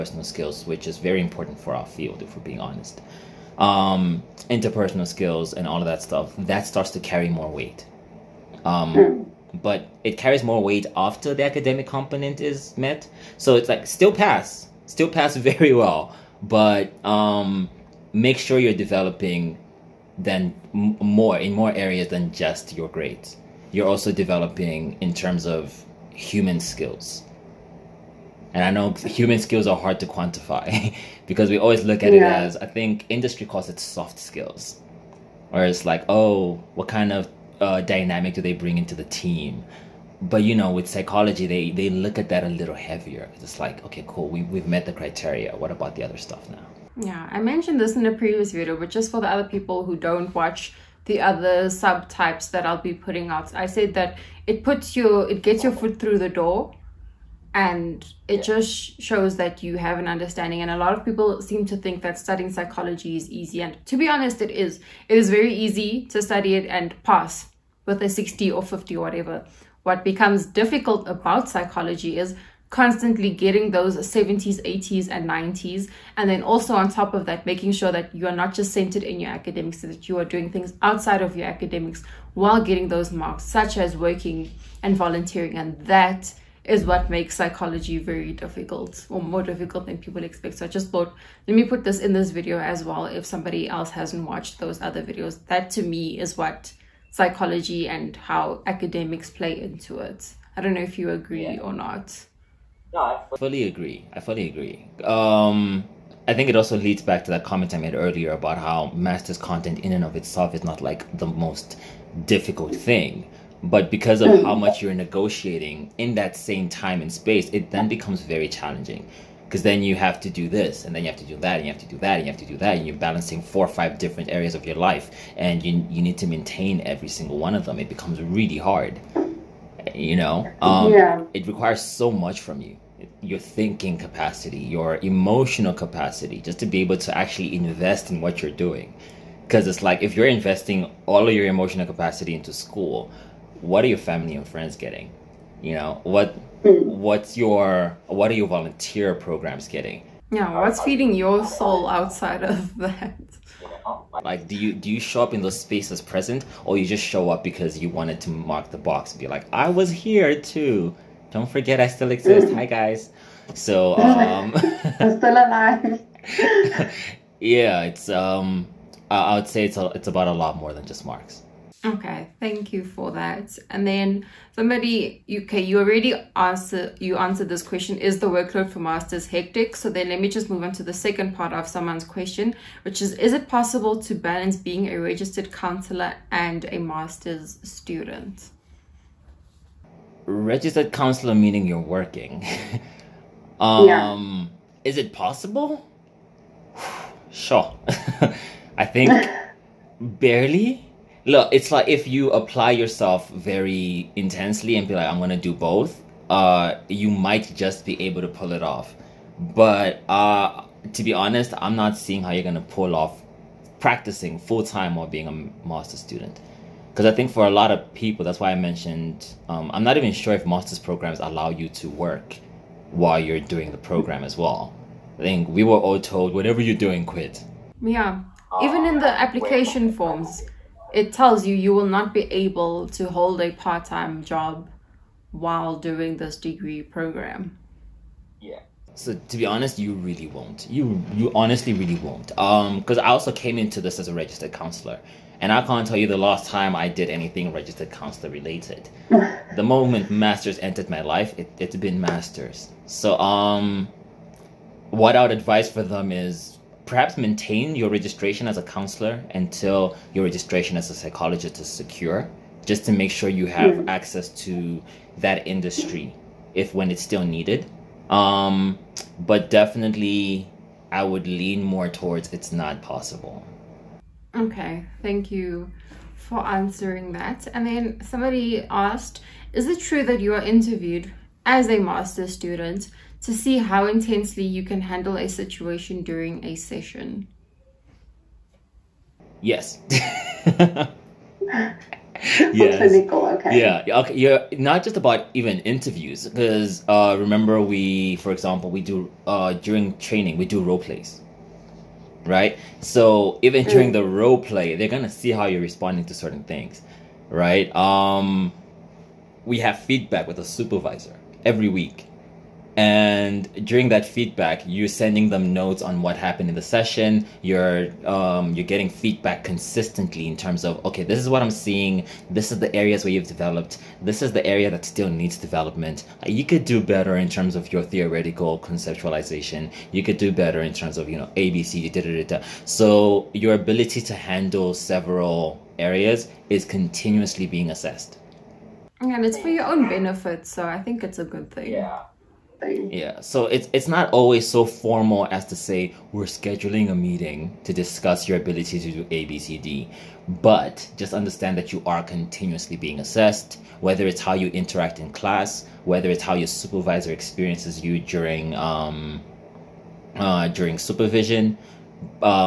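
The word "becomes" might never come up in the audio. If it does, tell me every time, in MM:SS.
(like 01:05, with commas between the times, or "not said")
01:10, 01:57, 02:07.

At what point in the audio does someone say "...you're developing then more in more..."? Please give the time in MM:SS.
00:18.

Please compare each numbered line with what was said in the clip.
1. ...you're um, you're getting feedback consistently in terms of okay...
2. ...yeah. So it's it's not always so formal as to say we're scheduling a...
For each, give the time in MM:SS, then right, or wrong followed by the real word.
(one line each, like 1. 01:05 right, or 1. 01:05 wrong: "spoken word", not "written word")
1. 05:17 right
2. 05:42 right.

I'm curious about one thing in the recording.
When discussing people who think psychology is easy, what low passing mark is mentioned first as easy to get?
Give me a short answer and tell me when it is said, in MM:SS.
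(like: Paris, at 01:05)
60, at 01:08.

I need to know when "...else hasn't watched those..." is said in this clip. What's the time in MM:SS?
01:33.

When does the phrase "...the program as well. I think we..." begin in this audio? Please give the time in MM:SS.
03:43.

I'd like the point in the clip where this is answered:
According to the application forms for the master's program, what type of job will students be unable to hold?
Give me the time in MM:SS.
03:53.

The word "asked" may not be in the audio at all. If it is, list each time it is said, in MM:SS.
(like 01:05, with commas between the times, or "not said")
04:38.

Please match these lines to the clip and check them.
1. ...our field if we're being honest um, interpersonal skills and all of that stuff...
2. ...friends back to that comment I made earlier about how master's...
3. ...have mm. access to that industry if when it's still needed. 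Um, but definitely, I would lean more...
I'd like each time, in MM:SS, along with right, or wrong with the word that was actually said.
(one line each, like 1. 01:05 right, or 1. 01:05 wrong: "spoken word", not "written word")
1. 00:01 right
2. 01:46 wrong: "leads", not "friends"
3. 04:23 right.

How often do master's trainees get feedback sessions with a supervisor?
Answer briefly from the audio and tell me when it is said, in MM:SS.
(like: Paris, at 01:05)
every week, at 05:11.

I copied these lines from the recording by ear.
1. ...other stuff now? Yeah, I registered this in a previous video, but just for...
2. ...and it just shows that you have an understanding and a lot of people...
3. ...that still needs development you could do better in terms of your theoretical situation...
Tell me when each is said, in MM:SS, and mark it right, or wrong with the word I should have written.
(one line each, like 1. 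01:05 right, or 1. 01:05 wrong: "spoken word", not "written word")
1. 00:46 wrong: "mentioned", not "registered"
2. 00:57 right
3. 05:24 wrong: "conceptualization", not "situation".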